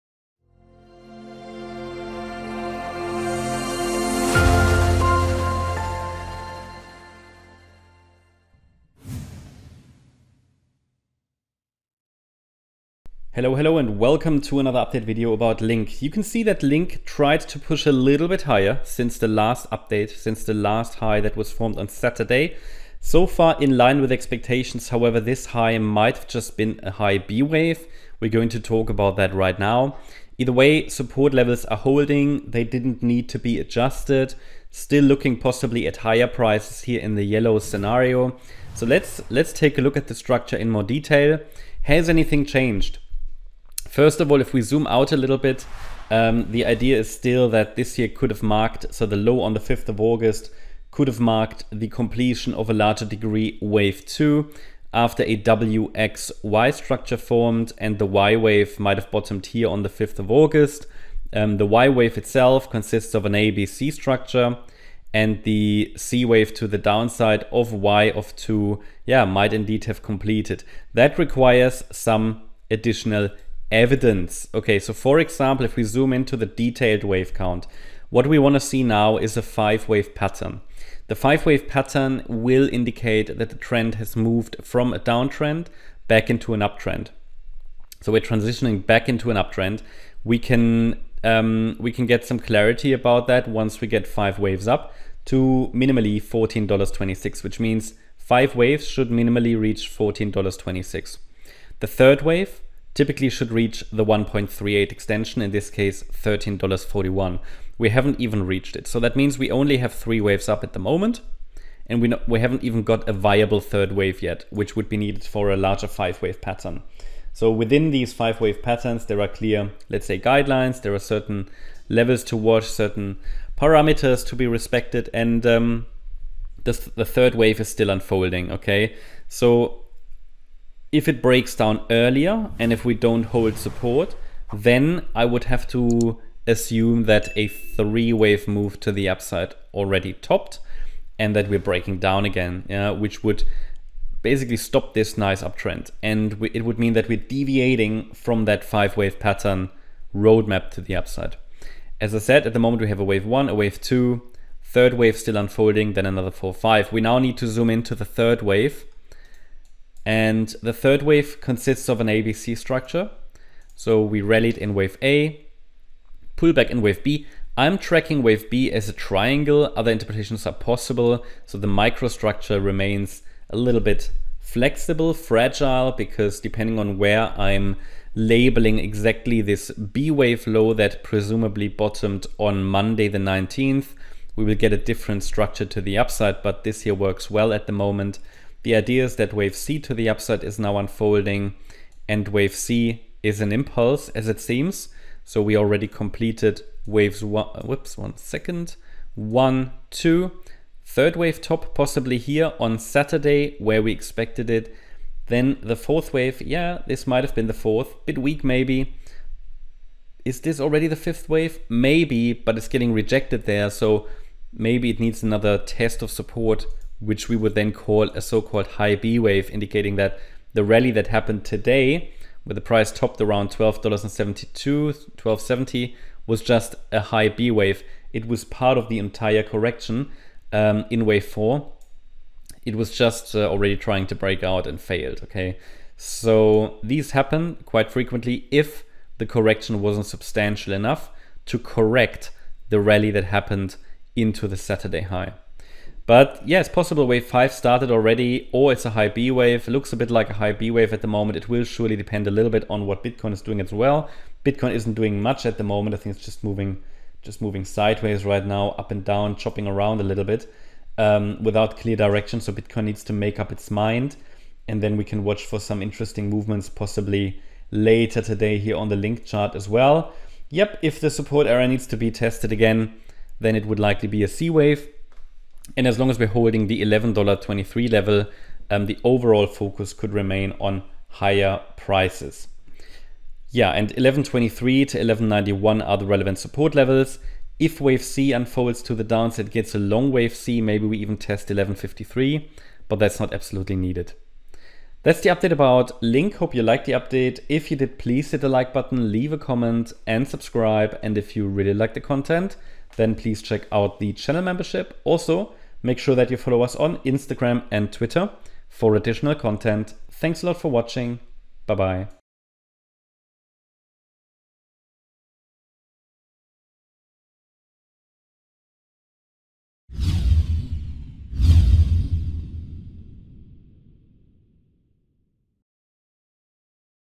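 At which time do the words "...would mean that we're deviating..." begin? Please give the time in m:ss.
2:26.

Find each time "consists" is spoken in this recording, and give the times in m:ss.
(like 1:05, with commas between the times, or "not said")
1:02, 2:41.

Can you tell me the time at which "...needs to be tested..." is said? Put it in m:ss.
4:31.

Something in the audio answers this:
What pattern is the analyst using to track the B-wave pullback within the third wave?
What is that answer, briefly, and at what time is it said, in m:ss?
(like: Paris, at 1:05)
triangle, at 2:48.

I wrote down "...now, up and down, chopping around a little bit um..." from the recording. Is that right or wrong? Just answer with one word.
right.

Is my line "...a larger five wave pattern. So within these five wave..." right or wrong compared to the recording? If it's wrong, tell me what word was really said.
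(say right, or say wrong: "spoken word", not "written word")
right.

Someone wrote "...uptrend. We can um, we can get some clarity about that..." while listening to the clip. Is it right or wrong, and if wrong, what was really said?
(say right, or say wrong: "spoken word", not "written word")
right.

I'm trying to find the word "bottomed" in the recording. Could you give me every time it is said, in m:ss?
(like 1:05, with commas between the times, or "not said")
0:59, 3:01.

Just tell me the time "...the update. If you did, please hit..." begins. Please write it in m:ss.
4:56.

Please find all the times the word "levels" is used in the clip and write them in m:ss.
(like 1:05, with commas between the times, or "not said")
0:31, 2:01, 4:37, 4:46.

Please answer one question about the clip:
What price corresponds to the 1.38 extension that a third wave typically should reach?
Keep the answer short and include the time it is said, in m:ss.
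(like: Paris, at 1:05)
$13.41, at 1:46.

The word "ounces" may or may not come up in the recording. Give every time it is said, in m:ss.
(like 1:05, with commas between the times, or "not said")
not said.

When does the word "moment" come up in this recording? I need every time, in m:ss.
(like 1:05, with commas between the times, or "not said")
1:50, 2:32, 3:07, 4:11, 4:15.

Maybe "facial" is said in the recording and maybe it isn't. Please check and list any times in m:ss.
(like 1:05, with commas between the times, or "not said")
not said.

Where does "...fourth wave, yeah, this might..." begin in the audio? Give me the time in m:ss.
3:25.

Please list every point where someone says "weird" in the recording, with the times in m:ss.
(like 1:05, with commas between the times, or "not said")
not said.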